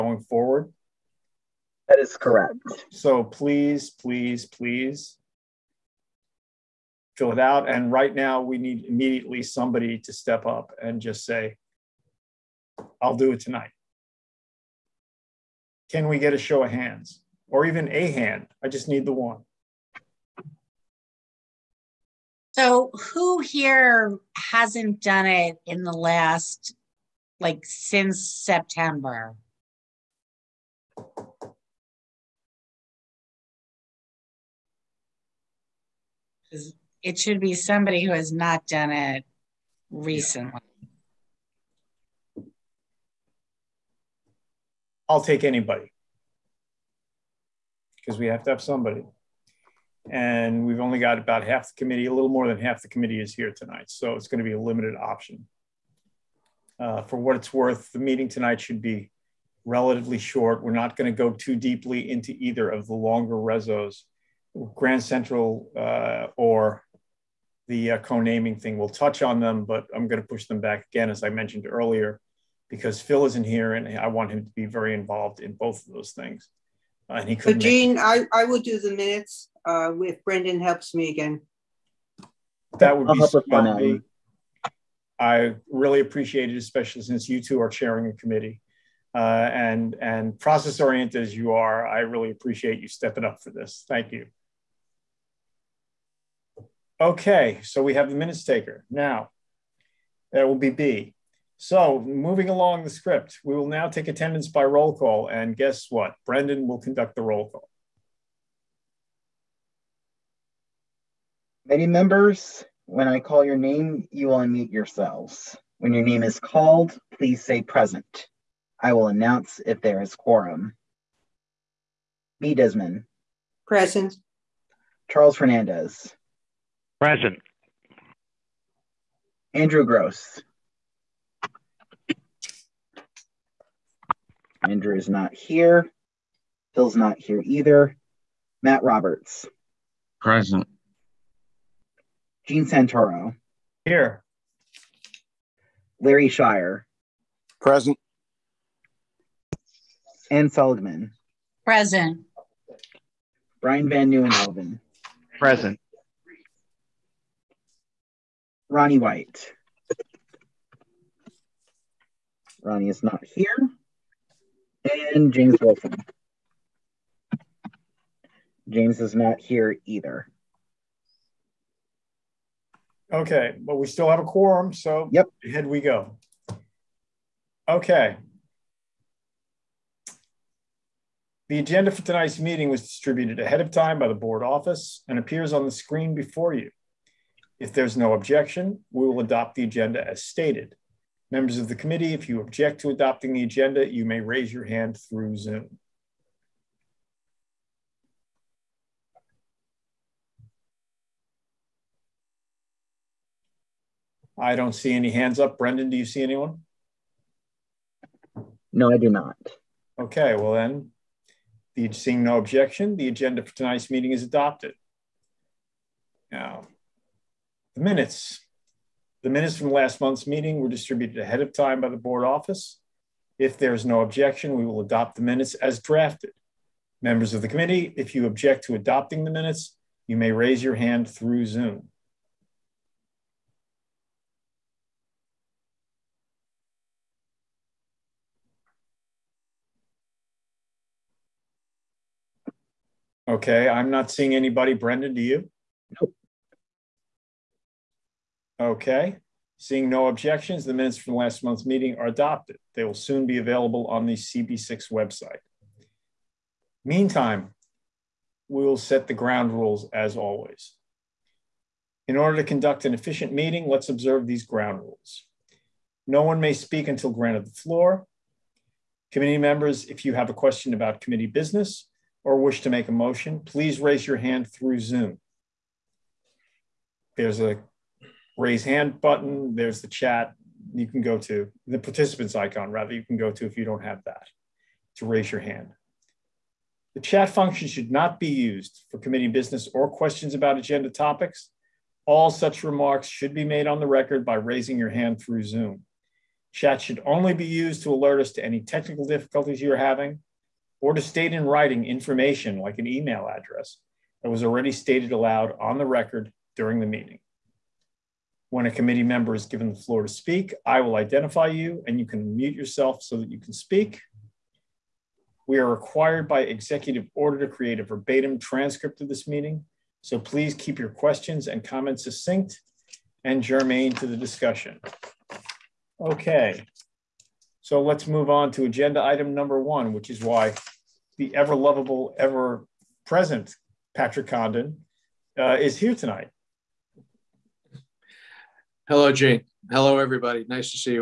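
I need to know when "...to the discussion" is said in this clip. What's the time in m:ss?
5:23.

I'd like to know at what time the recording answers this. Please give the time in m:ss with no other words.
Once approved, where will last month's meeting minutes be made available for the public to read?
4:14.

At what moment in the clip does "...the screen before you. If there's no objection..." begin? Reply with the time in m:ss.
3:05.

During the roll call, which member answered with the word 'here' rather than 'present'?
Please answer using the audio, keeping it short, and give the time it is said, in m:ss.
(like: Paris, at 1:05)
Gene Santoro, at 2:22.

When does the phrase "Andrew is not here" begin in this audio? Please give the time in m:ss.
2:14.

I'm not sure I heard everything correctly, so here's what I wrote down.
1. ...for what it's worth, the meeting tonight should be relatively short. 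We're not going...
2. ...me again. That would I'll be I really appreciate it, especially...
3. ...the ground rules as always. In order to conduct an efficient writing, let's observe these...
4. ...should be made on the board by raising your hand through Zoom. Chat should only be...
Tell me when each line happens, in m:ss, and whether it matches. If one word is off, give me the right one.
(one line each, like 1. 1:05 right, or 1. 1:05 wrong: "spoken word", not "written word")
1. 0:57 right
2. 1:20 right
3. 4:19 wrong: "meeting", not "writing"
4. 4:53 wrong: "record", not "board".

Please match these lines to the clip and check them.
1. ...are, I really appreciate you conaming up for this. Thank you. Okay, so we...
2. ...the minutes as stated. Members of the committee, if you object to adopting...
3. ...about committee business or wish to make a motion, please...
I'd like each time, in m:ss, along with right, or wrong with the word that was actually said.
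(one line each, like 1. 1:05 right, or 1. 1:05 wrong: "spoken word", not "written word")
1. 1:31 wrong: "stepping", not "conaming"
2. 3:45 wrong: "drafted", not "stated"
3. 4:30 right.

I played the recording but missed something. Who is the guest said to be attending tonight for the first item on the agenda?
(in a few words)
Patrick Condon.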